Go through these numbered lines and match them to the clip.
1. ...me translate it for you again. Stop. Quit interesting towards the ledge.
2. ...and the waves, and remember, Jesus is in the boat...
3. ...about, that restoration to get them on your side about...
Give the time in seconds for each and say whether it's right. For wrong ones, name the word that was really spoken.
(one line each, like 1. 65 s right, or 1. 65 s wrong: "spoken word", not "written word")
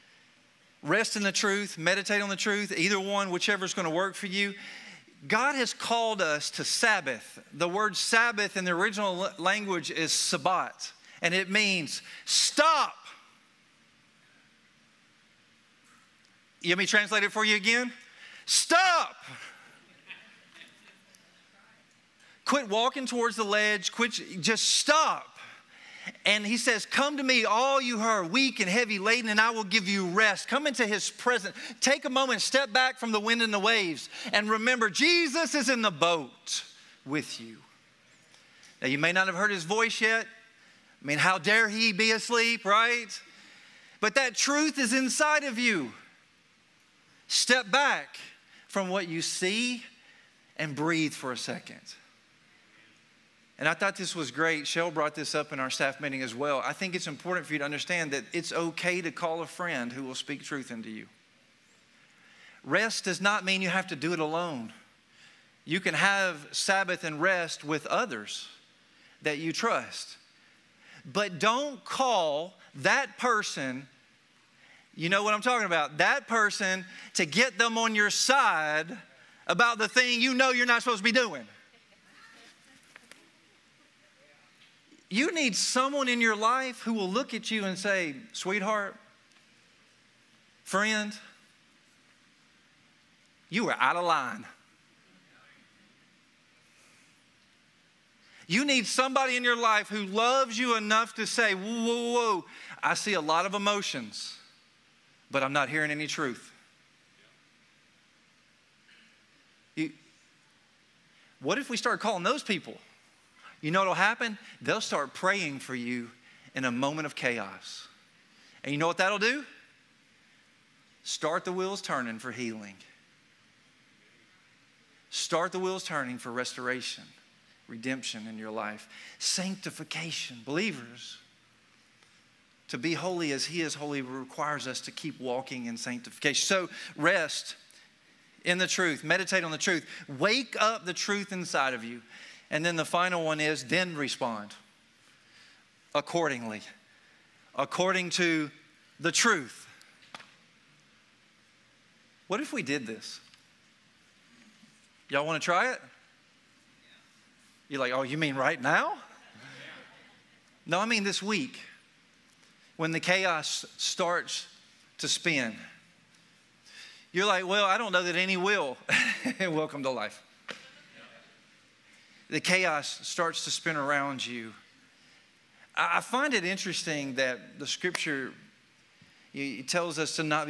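1. 16 s wrong: "walking", not "interesting"
2. 33 s right
3. 75 s wrong: "person", not "restoration".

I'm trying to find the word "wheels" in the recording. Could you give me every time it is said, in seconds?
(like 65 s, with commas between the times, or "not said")
121 s, 125 s.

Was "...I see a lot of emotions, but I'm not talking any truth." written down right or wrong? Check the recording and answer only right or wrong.
wrong.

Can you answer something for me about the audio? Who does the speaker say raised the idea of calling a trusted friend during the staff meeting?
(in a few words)
Shell.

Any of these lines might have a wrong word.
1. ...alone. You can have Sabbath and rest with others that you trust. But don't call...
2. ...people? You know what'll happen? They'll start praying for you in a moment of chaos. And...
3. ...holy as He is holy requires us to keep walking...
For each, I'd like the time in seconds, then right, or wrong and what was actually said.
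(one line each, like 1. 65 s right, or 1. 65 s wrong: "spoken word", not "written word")
1. 64 s right
2. 112 s right
3. 132 s right.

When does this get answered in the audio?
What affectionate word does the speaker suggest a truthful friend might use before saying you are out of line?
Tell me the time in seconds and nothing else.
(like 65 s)
88 s.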